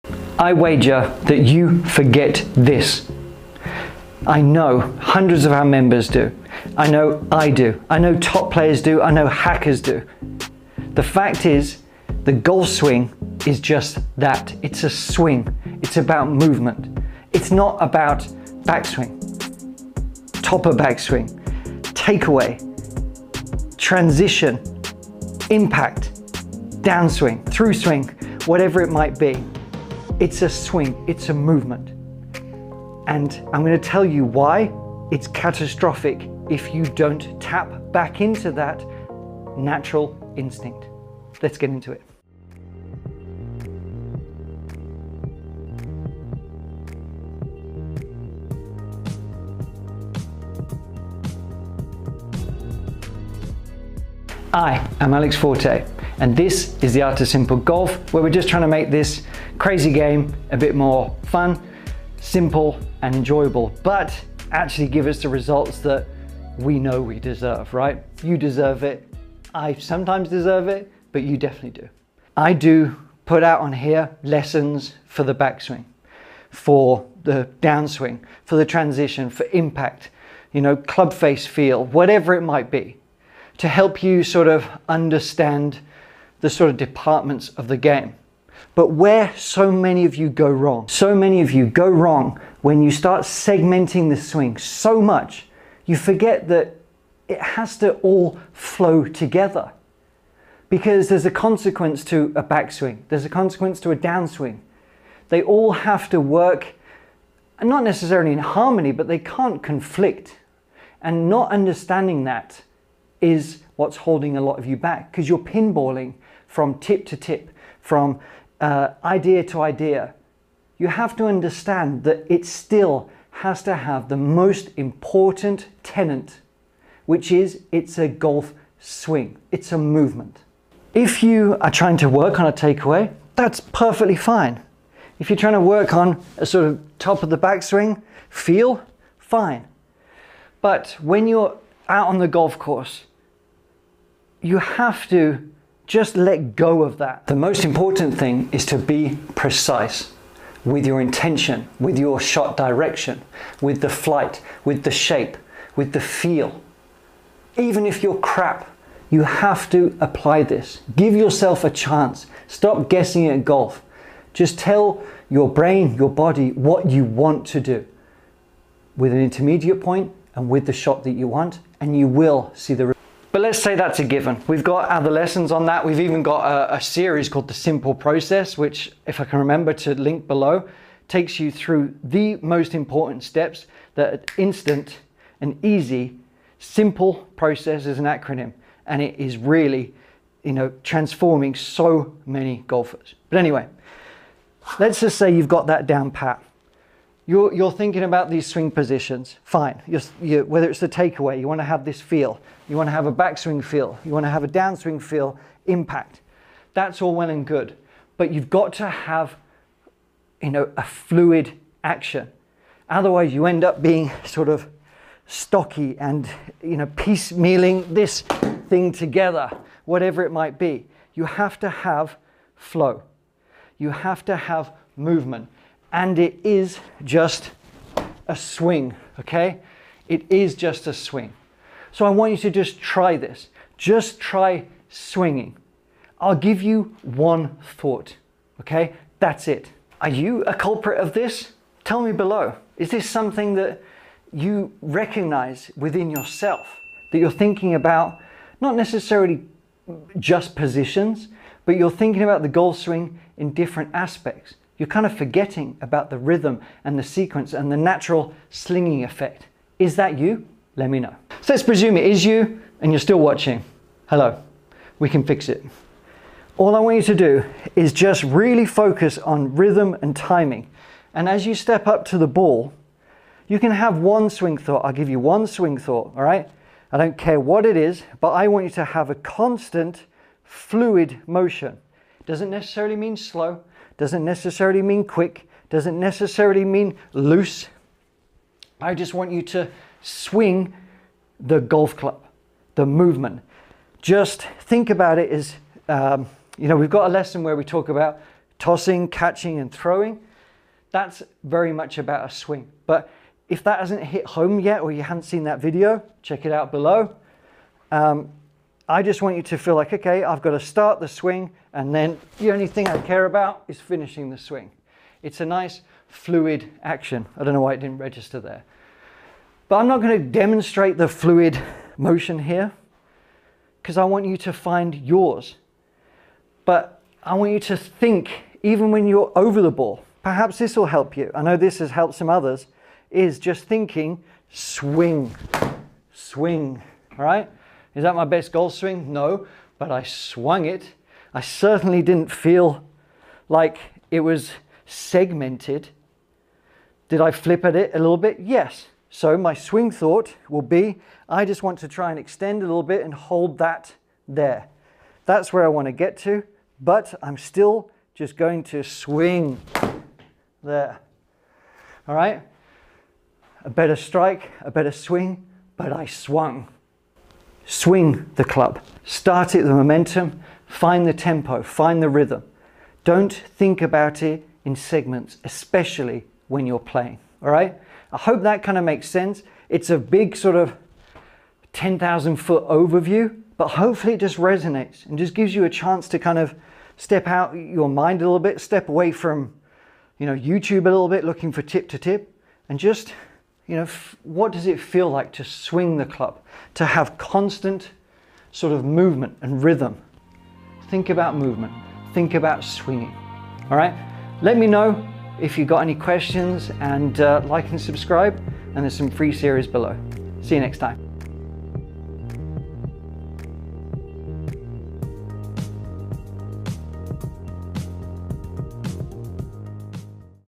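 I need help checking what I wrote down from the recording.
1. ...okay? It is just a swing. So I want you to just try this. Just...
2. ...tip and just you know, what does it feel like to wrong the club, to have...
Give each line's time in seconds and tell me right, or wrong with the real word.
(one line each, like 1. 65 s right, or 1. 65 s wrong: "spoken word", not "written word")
1. 229 s right
2. 391 s wrong: "swing", not "wrong".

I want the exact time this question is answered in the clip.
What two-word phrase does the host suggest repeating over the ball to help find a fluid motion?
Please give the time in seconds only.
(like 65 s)
334 s.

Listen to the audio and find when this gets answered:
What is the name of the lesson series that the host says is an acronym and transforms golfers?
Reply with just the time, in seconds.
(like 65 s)
177 s.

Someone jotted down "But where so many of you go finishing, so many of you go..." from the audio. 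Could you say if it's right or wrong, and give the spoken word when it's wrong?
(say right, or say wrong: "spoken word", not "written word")
wrong: "wrong", not "finishing".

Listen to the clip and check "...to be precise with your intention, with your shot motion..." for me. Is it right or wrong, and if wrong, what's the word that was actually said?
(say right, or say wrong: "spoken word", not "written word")
wrong: "direction", not "motion".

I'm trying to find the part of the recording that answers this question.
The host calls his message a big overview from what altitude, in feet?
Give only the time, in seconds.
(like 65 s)
381 s.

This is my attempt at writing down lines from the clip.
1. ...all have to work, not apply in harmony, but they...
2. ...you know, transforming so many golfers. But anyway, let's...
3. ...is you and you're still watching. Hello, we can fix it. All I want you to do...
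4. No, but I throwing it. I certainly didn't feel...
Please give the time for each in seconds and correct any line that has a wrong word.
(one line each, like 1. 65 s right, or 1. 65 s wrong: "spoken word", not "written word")
1. 105 s wrong: "necessarily", not "apply"
2. 190 s right
3. 262 s right
4. 339 s wrong: "swung", not "throwing".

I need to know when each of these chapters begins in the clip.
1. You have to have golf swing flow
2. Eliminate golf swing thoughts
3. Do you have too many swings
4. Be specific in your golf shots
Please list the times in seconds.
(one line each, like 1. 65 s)
1. 225 s
2. 325 s
3. 71 s
4. 140 s.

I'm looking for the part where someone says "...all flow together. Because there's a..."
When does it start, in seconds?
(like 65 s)
97 s.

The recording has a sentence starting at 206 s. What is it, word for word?
That's all well and good, but you've got to have, you know, a fluid action.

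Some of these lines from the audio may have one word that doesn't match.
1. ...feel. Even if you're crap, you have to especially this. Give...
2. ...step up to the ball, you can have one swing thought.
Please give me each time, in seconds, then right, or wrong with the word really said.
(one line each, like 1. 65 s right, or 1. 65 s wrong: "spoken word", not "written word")
1. 155 s wrong: "apply", not "especially"
2. 271 s right.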